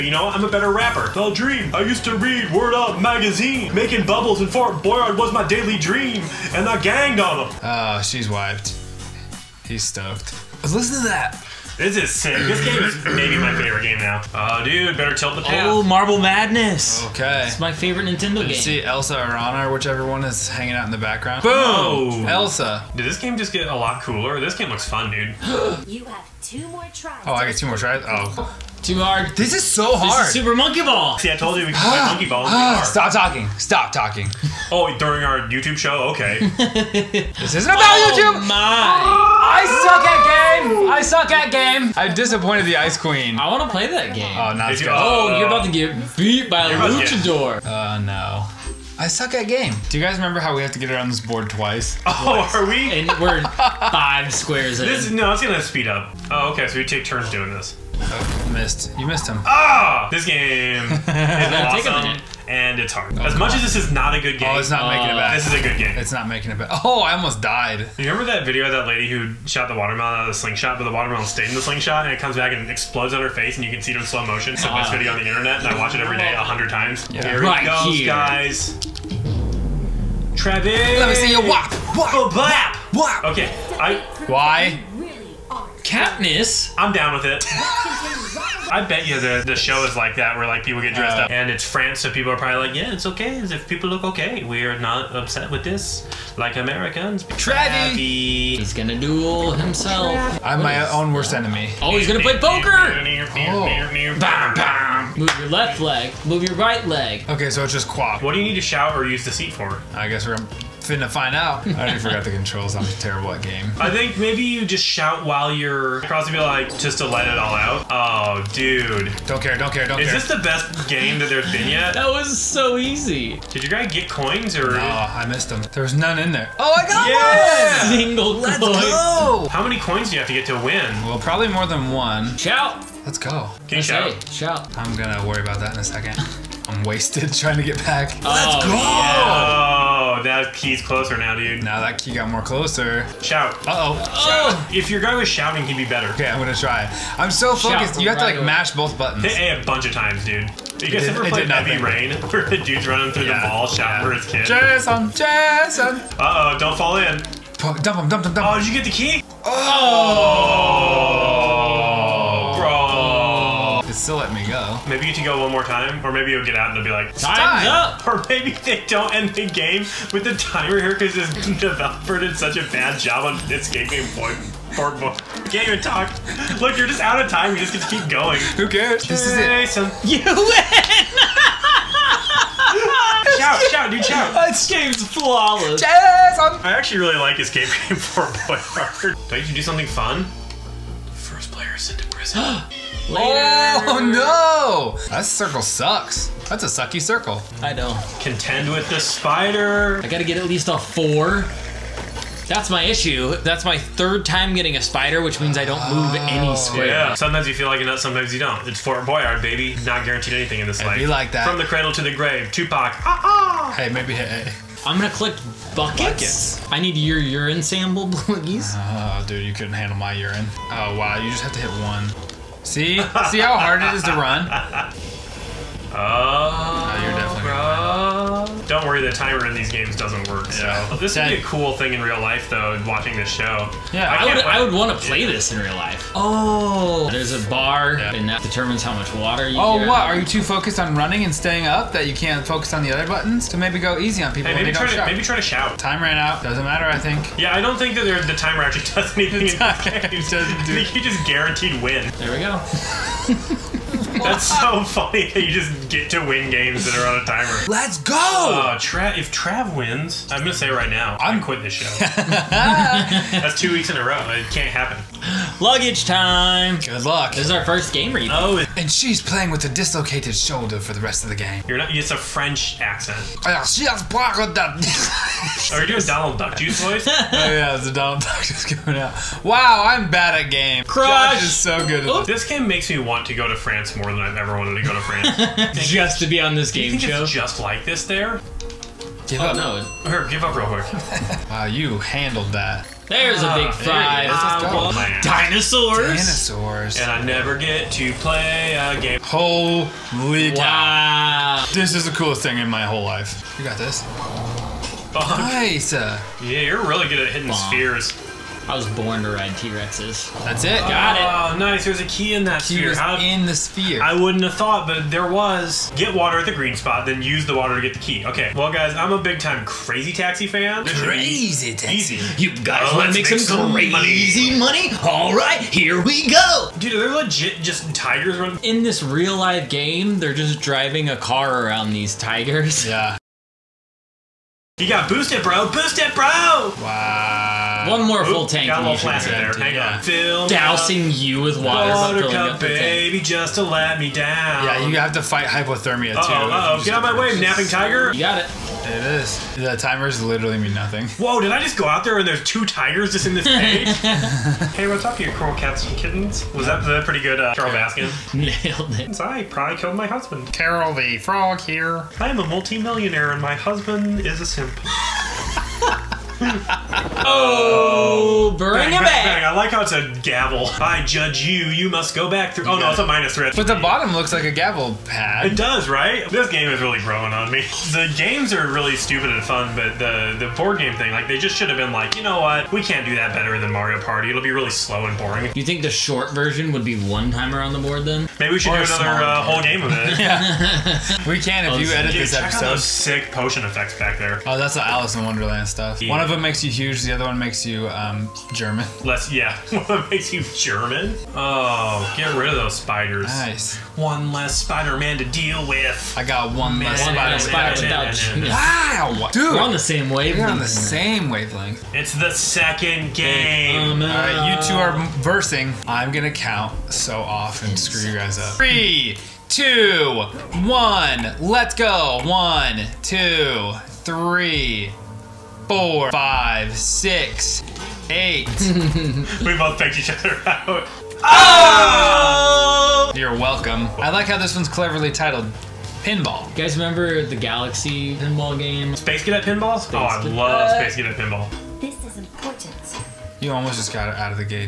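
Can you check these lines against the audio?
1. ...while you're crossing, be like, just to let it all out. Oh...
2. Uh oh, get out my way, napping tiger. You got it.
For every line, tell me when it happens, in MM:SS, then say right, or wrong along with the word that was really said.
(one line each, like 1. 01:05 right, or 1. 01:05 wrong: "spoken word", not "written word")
1. 01:55 right
2. 05:46 right.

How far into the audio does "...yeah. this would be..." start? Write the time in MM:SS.
03:50.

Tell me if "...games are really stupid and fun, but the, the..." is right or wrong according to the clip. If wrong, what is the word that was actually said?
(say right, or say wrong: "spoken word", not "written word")
right.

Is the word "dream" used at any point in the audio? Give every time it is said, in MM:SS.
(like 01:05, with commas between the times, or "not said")
00:01, 00:05.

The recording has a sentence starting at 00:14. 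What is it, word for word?
Oh, dude, better tilt the path.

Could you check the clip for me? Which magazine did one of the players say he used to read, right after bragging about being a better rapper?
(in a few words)
Word Up.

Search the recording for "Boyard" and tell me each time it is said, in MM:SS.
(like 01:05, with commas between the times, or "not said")
00:04, 03:29.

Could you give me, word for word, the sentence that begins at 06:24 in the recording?
It'll be really slow and boring.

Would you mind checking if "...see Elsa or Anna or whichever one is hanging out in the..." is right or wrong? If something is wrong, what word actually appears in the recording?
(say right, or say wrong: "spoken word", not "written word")
right.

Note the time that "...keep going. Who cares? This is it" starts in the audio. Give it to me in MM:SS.
02:57.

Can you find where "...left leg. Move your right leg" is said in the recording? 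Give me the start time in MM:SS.
01:45.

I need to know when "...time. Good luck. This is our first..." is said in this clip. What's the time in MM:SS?
04:26.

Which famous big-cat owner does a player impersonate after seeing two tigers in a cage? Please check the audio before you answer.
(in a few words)
Carole Baskin.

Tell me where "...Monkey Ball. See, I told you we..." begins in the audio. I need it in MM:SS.
00:30.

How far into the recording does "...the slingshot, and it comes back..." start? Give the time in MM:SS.
01:11.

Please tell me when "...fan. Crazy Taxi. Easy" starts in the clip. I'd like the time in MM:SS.
05:20.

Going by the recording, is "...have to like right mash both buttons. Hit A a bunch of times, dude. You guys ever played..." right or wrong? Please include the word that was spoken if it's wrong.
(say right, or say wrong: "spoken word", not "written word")
right.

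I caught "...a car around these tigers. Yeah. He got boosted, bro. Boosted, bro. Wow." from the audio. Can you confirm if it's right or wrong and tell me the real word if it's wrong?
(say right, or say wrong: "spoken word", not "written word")
right.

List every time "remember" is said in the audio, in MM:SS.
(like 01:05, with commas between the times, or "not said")
00:50, 01:08, 07:16.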